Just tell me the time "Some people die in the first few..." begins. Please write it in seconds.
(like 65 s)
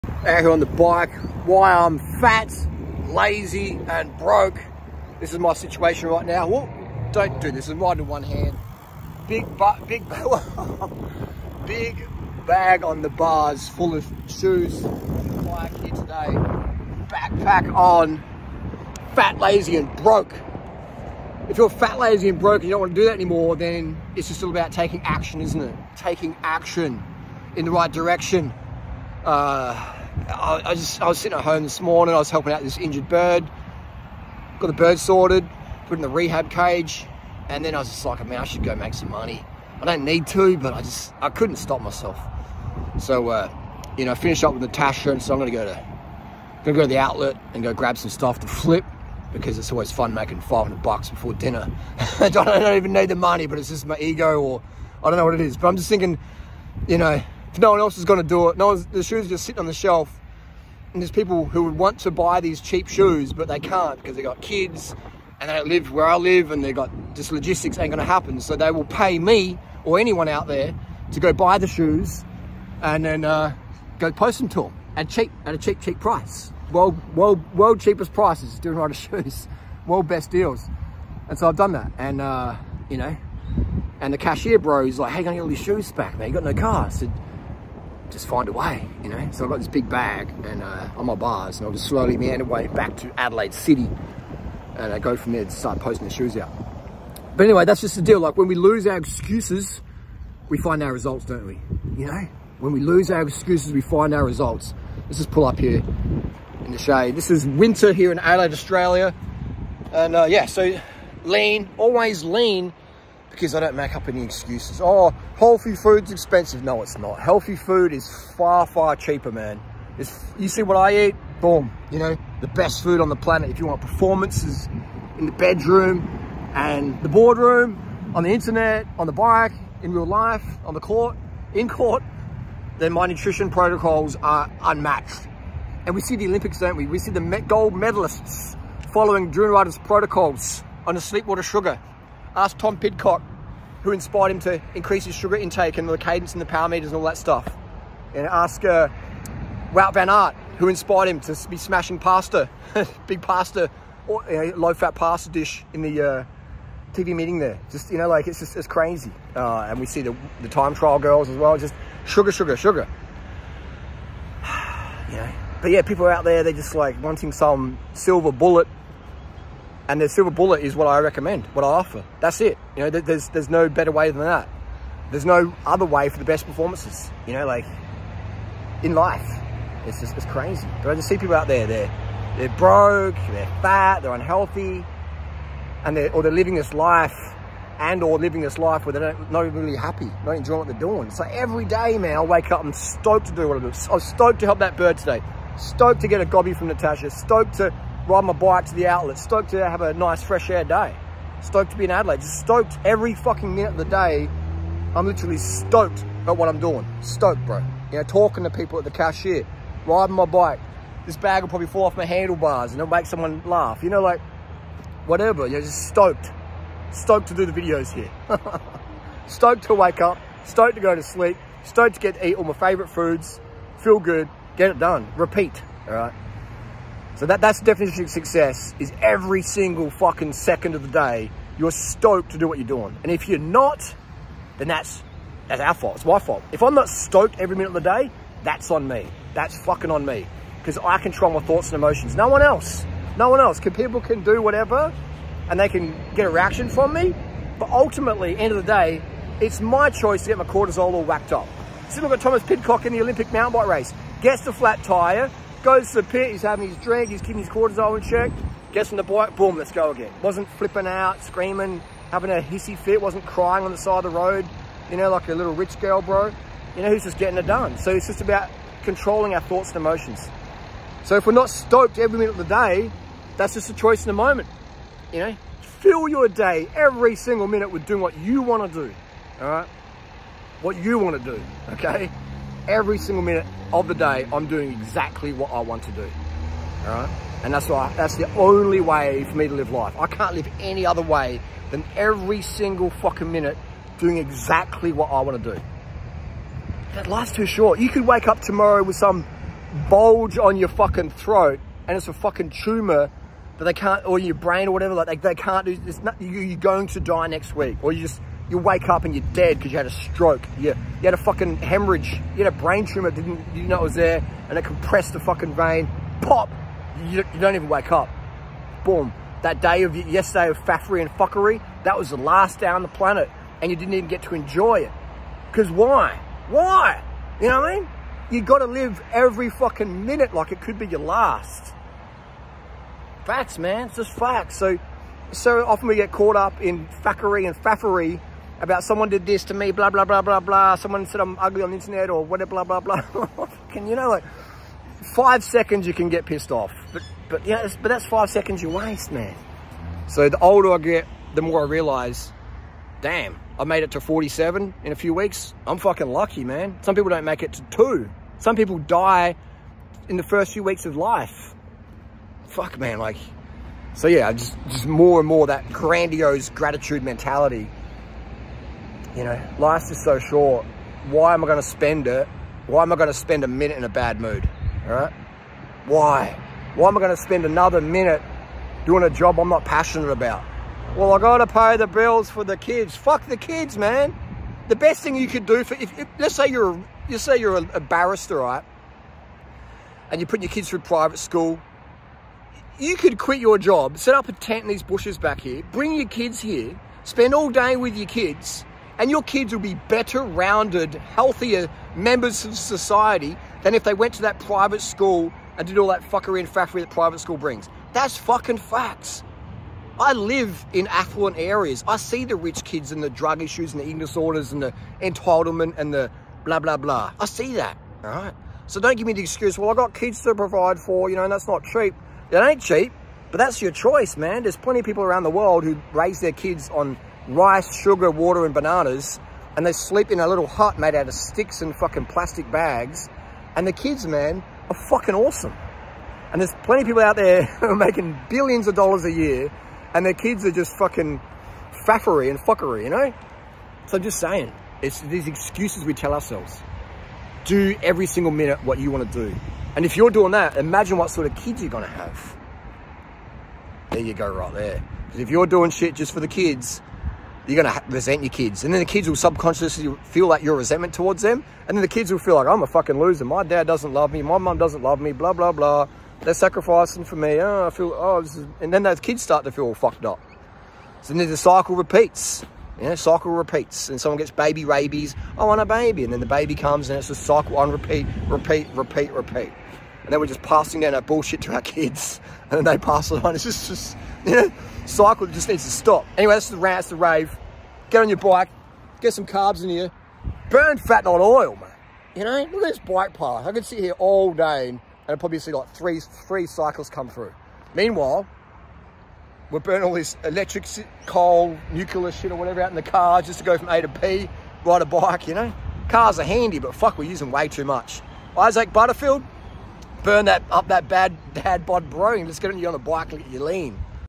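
358 s.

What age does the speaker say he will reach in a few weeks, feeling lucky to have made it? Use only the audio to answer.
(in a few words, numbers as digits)
47.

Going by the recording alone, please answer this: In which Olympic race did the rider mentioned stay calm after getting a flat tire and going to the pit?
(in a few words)
Mountain bike race.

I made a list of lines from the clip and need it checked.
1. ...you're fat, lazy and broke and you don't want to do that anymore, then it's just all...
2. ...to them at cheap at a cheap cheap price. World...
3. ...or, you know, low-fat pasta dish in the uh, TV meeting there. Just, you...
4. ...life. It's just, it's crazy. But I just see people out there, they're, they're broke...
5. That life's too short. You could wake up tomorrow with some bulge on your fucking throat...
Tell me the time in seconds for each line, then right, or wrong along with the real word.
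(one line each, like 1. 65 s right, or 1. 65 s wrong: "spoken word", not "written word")
1. 21 s right
2. 74 s right
3. 154 s right
4. 178 s right
5. 296 s right.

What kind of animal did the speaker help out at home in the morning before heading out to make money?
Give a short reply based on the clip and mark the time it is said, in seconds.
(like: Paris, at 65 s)
Injured bird, at 32 s.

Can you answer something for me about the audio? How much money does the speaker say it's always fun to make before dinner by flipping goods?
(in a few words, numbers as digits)
$500.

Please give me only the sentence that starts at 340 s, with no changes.
Someone said I'm ugly on the internet or whatever, blah, blah, blah.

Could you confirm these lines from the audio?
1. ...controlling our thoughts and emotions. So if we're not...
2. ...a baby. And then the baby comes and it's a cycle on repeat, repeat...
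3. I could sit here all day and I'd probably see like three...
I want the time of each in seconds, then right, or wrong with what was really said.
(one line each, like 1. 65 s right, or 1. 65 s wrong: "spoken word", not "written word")
1. 268 s right
2. 475 s right
3. 493 s right.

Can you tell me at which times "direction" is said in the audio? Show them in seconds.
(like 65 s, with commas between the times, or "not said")
27 s.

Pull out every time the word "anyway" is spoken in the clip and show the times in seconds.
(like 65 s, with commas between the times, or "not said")
97 s, 486 s.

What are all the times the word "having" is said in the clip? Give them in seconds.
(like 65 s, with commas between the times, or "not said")
256 s, 262 s.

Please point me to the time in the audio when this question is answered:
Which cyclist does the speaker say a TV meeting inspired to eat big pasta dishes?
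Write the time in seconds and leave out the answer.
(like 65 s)
149 s.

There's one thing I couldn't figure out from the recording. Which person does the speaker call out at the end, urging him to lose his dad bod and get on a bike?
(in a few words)
Isaac Butterfield.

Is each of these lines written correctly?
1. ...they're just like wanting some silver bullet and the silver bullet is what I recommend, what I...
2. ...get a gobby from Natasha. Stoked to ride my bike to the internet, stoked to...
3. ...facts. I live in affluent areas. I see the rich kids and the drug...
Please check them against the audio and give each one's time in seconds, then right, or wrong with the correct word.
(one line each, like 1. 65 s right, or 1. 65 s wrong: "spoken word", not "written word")
1. 166 s right
2. 196 s wrong: "outlet", not "internet"
3. 408 s right.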